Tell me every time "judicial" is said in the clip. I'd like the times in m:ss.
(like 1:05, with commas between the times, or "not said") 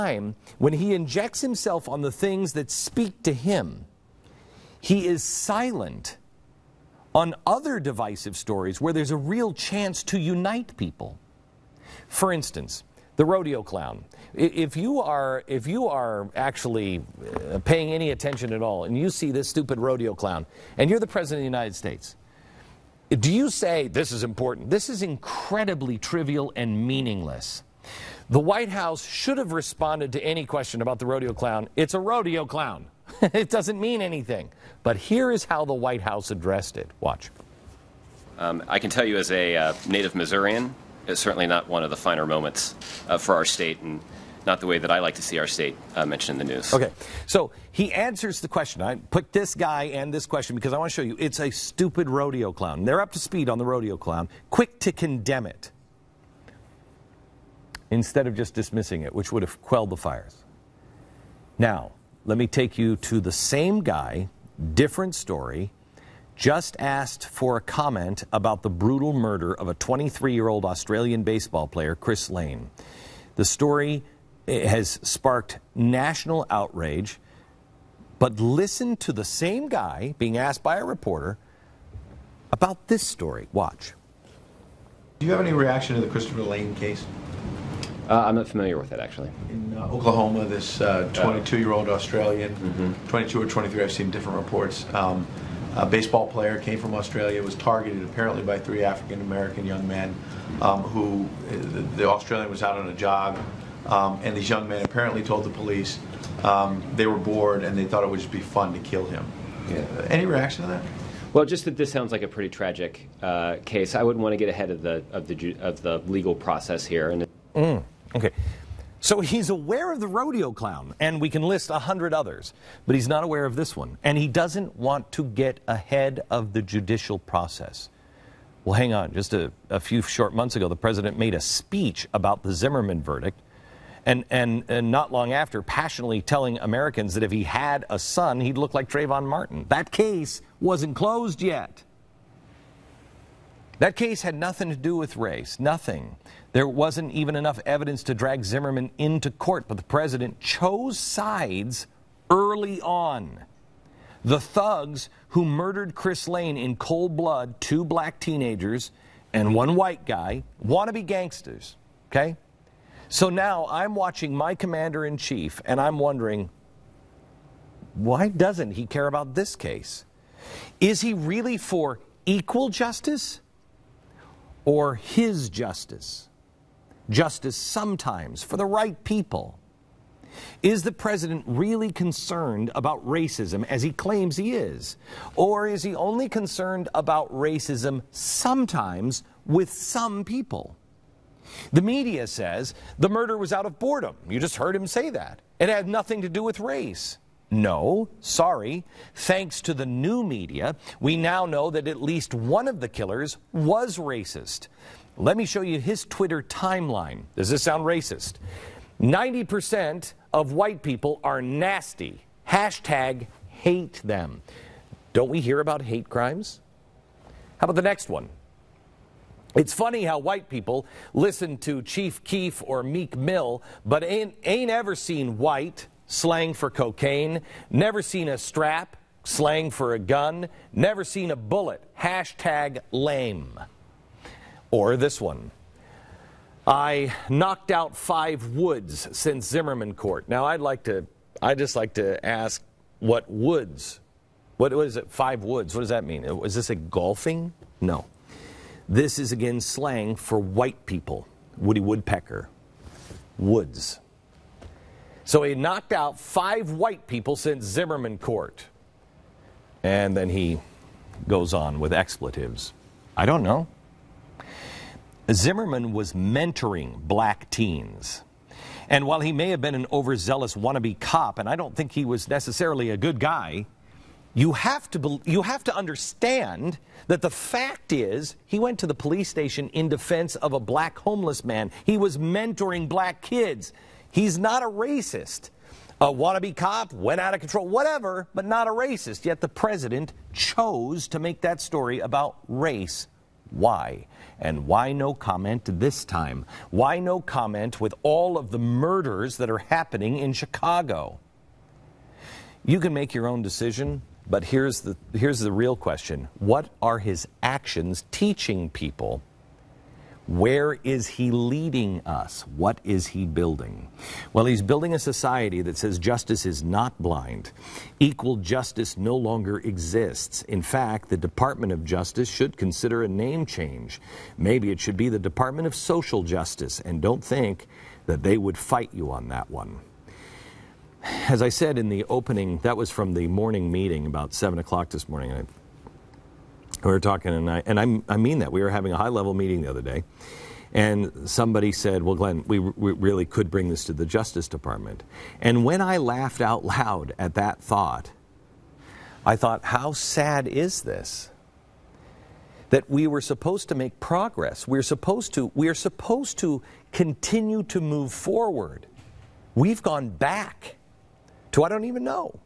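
2:06.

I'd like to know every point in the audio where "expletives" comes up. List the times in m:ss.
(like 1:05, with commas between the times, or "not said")
4:21.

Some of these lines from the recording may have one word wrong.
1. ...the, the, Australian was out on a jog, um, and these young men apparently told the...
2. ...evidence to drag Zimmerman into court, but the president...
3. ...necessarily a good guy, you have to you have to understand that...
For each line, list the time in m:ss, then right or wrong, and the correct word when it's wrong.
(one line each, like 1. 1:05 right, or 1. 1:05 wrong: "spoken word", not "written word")
1. 1:41 right
2. 2:27 right
3. 4:32 right.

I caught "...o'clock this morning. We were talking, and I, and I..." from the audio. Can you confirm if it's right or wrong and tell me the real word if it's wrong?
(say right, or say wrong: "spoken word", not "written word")
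right.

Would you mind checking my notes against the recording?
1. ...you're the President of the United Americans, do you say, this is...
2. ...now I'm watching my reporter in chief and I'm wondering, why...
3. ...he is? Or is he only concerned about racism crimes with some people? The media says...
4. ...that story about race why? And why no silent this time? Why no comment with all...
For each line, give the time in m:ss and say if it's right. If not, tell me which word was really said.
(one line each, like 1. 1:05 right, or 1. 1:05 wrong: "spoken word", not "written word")
1. 0:20 wrong: "States", not "Americans"
2. 2:43 wrong: "commander", not "reporter"
3. 3:04 wrong: "sometimes", not "crimes"
4. 4:51 wrong: "comment", not "silent".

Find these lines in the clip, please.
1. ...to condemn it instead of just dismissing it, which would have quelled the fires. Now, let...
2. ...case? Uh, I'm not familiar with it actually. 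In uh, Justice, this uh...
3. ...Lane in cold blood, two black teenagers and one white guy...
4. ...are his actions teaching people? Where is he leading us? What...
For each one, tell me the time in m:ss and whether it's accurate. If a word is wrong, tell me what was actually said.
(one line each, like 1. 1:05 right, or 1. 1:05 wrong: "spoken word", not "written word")
1. 0:54 right
2. 1:26 wrong: "Oklahoma", not "Justice"
3. 2:36 right
4. 5:06 right.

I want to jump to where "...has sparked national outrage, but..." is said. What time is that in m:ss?
1:14.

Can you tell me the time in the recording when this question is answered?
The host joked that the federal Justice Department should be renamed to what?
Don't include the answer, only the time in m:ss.
5:25.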